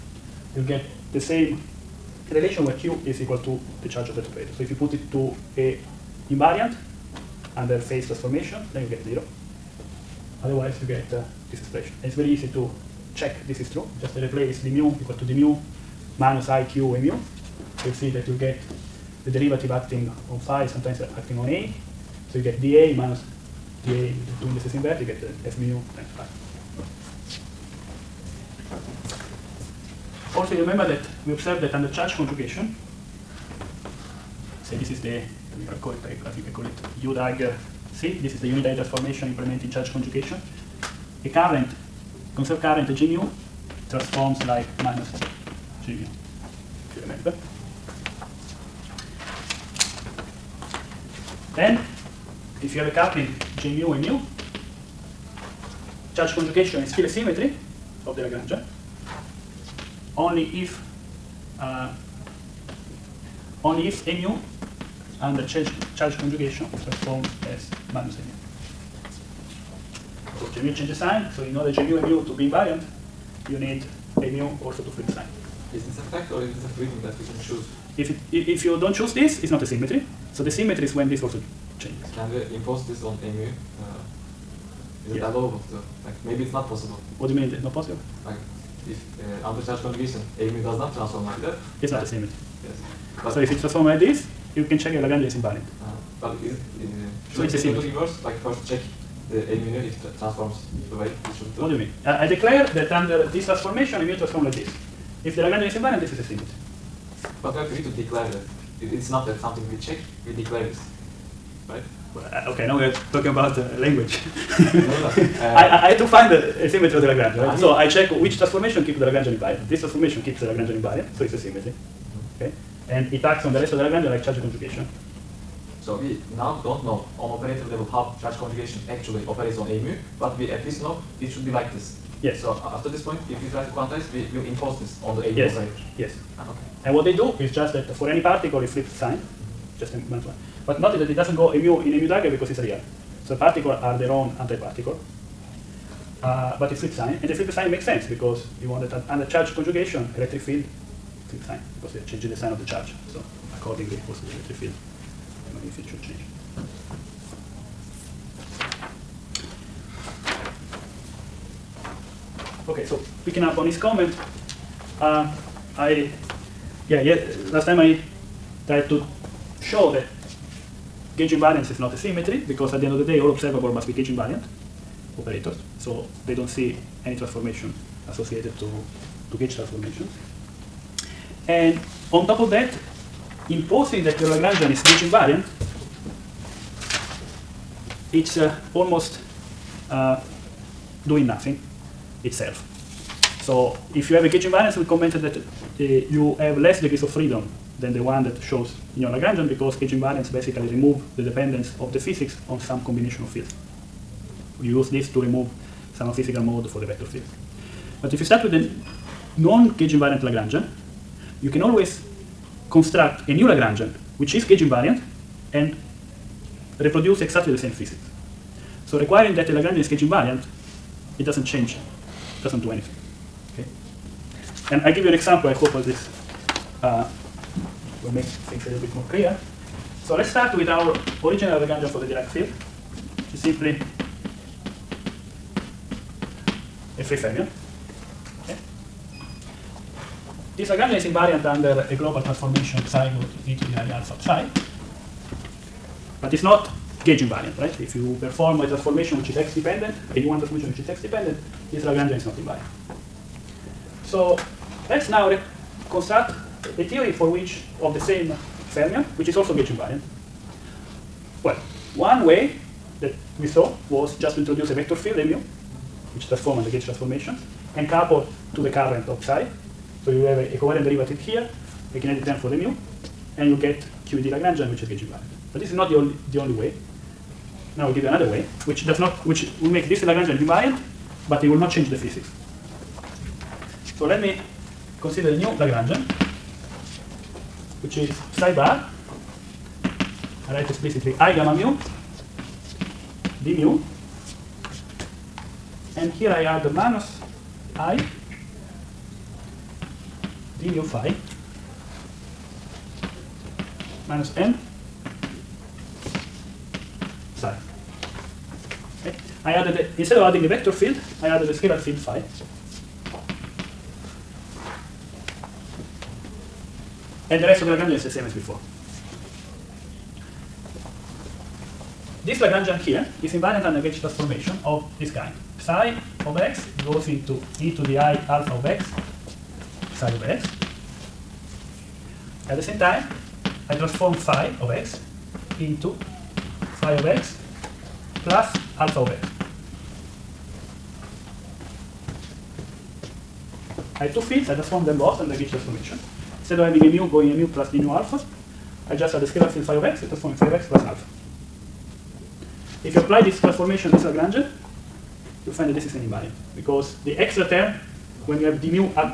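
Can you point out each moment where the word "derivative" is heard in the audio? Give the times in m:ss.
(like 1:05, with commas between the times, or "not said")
0:19, 4:30.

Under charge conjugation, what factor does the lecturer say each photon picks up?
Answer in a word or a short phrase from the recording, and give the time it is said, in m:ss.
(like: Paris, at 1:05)
minus one, at 2:20.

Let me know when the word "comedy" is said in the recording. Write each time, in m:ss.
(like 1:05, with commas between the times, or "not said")
not said.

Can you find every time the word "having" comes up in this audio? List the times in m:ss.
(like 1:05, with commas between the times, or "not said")
5:46.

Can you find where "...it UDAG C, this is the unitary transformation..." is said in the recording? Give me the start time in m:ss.
0:36.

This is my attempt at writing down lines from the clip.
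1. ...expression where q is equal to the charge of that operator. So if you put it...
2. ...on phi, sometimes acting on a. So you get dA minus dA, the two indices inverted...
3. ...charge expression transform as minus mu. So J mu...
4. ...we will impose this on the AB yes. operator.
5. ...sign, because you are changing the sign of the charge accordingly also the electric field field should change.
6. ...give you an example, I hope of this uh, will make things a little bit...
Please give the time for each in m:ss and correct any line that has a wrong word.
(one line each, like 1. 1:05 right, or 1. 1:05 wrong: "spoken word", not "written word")
1. 0:02 wrong: "relation", not "expression"
2. 0:20 right
3. 1:05 wrong: "conjugation", not "expression"
4. 2:14 right
5. 2:31 right
6. 3:44 right.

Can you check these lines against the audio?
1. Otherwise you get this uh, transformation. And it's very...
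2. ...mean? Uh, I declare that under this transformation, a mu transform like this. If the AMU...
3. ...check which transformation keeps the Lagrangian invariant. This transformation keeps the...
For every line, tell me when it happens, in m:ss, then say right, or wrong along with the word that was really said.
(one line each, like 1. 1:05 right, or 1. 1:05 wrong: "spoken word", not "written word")
1. 0:10 wrong: "expression", not "transformation"
2. 1:41 wrong: "Lagrangian", not "AMU"
3. 1:57 right.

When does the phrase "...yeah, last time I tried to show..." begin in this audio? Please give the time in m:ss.
2:46.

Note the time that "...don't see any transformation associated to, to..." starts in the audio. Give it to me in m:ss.
2:56.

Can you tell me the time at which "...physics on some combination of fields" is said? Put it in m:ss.
3:21.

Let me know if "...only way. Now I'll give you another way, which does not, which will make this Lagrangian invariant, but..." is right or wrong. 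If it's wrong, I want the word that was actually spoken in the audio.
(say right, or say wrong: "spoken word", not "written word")
right.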